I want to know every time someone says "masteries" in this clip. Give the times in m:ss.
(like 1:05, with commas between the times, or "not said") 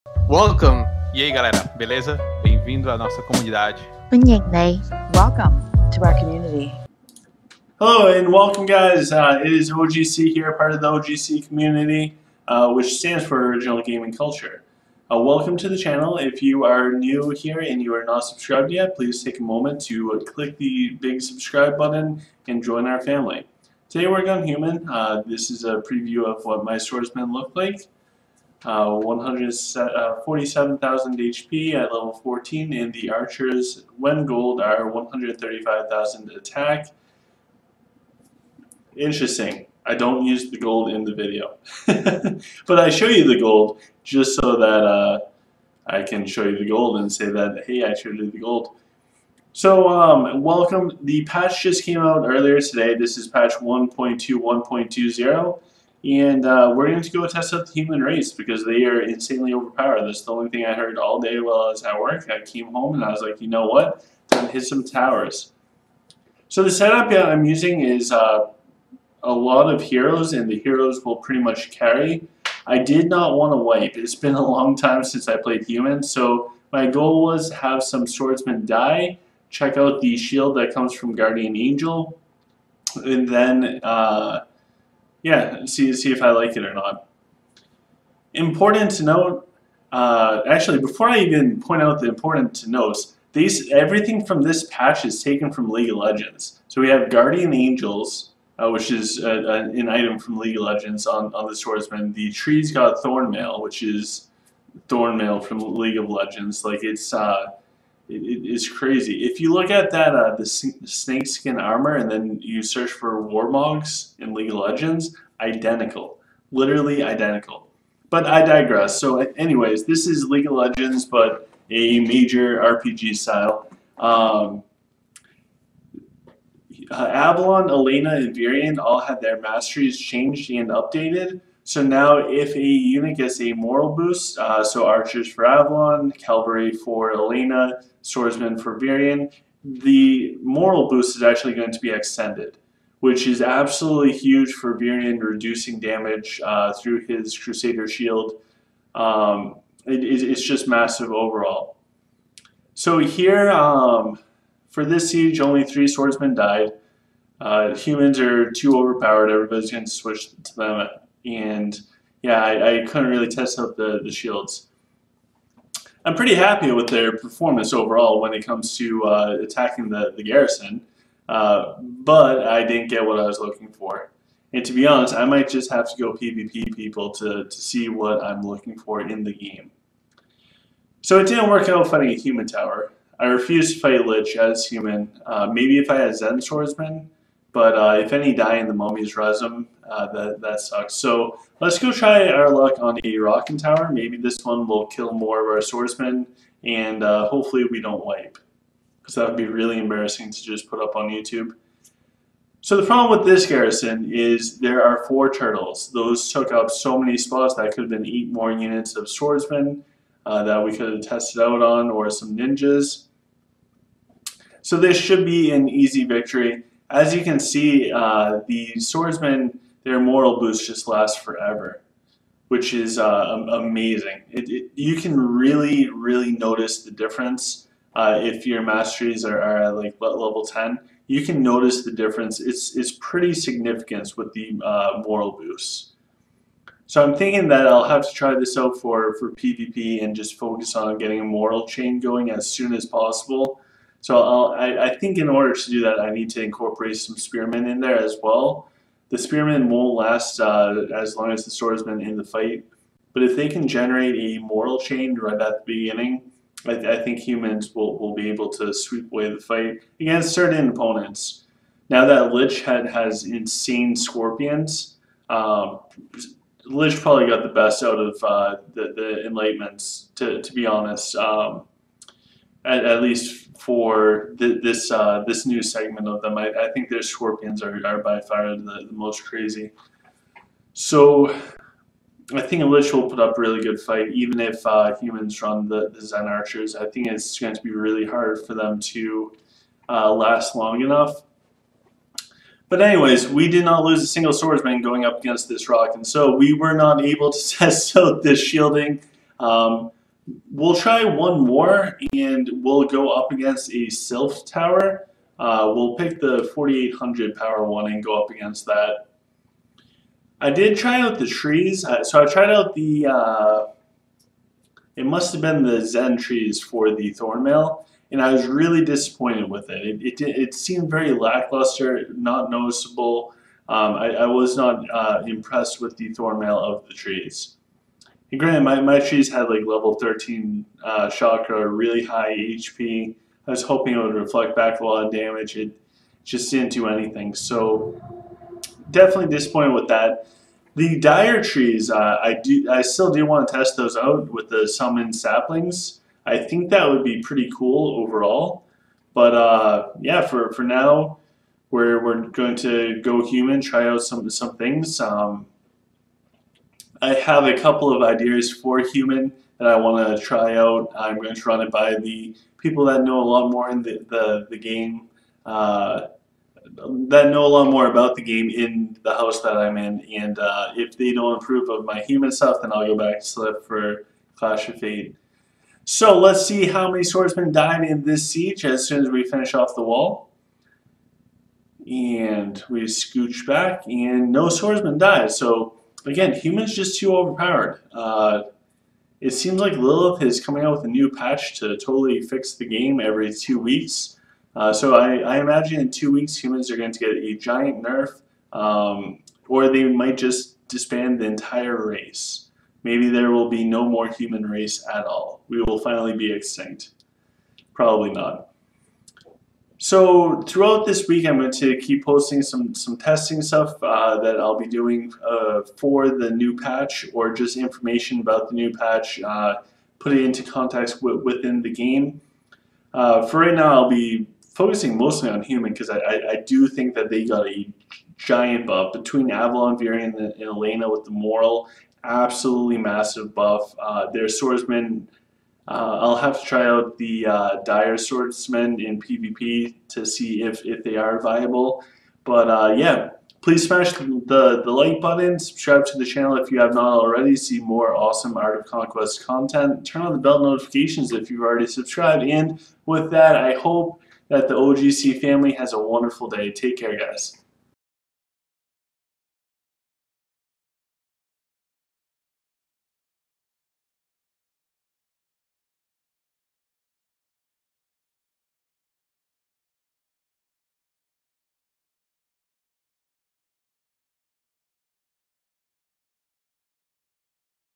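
2:09, 3:48.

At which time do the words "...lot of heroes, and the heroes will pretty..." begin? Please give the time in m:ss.
1:09.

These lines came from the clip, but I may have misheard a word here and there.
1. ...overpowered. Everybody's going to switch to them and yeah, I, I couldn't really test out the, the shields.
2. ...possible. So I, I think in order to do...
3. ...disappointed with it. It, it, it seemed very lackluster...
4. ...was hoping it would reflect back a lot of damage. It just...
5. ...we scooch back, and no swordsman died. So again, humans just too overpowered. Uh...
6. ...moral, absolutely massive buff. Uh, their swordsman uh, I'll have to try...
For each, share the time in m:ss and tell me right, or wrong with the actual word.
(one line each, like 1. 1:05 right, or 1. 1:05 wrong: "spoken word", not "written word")
1. 2:38 right
2. 4:02 right
3. 5:18 right
4. 5:33 right
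5. 6:22 right
6. 7:11 right.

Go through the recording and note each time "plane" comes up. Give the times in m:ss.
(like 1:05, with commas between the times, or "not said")
not said.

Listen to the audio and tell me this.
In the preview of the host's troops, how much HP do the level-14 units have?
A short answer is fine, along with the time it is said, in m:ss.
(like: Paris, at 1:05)
147,000, at 0:28.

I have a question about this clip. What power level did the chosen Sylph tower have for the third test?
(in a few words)
4800.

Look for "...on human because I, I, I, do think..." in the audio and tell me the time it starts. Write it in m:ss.
7:05.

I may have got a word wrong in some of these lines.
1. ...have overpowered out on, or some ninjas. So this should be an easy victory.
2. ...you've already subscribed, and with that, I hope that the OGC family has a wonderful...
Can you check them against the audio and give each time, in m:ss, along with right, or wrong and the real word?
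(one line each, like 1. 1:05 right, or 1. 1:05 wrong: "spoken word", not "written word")
1. 3:30 wrong: "tested", not "overpowered"
2. 7:31 right.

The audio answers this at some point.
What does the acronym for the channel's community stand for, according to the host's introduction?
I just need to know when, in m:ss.
0:13.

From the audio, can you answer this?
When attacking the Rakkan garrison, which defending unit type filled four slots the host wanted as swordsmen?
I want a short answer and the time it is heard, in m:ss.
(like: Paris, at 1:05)
turtles, at 3:25.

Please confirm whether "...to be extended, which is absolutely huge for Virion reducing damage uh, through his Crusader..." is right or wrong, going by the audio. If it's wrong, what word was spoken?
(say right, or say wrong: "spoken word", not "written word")
right.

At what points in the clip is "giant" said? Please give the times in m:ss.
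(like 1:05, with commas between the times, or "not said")
6:37, 7:08.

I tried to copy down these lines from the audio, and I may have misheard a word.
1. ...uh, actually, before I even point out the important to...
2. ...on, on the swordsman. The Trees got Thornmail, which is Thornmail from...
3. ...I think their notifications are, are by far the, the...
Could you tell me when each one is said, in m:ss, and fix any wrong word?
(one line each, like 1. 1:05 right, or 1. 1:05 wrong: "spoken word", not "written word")
1. 1:29 right
2. 1:41 right
3. 4:36 wrong: "scorpions", not "notifications".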